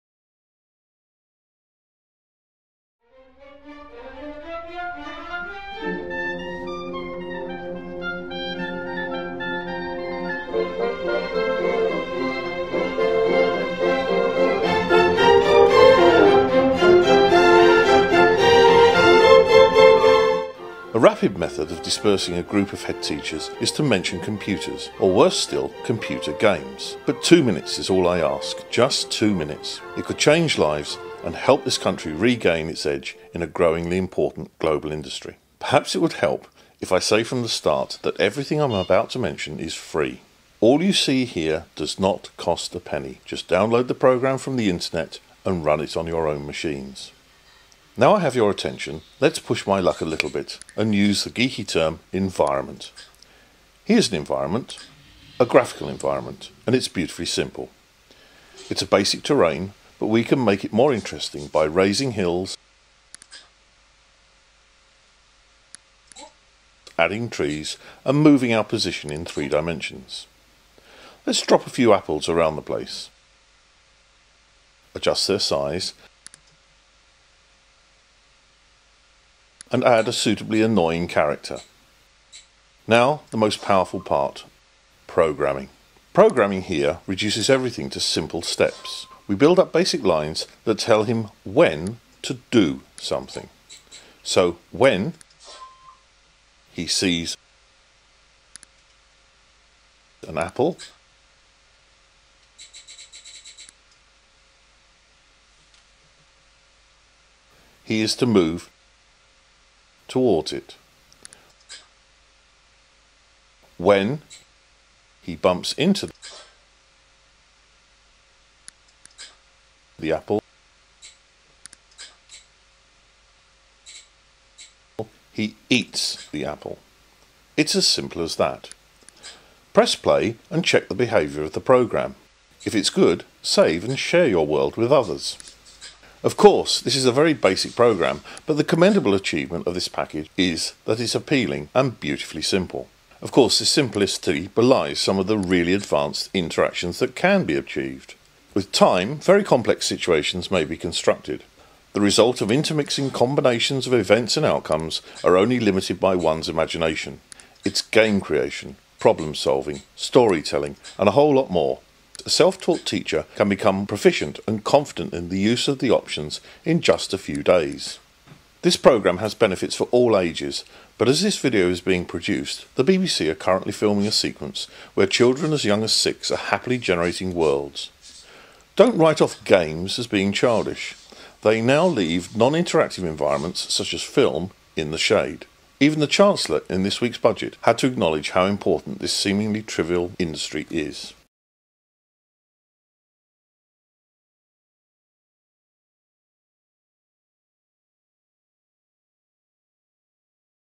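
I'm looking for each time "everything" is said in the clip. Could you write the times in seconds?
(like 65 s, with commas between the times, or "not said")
38 s, 87 s.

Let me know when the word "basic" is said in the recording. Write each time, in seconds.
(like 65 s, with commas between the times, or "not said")
58 s, 89 s, 137 s.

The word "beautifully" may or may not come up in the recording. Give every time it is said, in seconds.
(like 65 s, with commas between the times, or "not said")
56 s, 141 s.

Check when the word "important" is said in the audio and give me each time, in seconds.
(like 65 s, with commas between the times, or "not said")
33 s, 188 s.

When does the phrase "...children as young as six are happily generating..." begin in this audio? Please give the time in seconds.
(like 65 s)
175 s.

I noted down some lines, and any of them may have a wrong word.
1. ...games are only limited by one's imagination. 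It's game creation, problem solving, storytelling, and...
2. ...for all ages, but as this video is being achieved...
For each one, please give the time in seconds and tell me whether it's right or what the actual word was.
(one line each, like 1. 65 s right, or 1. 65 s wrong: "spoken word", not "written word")
1. 154 s wrong: "outcomes", not "games"
2. 169 s wrong: "produced", not "achieved".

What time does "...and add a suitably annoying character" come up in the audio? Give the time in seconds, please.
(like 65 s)
79 s.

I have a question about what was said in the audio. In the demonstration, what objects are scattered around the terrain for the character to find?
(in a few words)
apples.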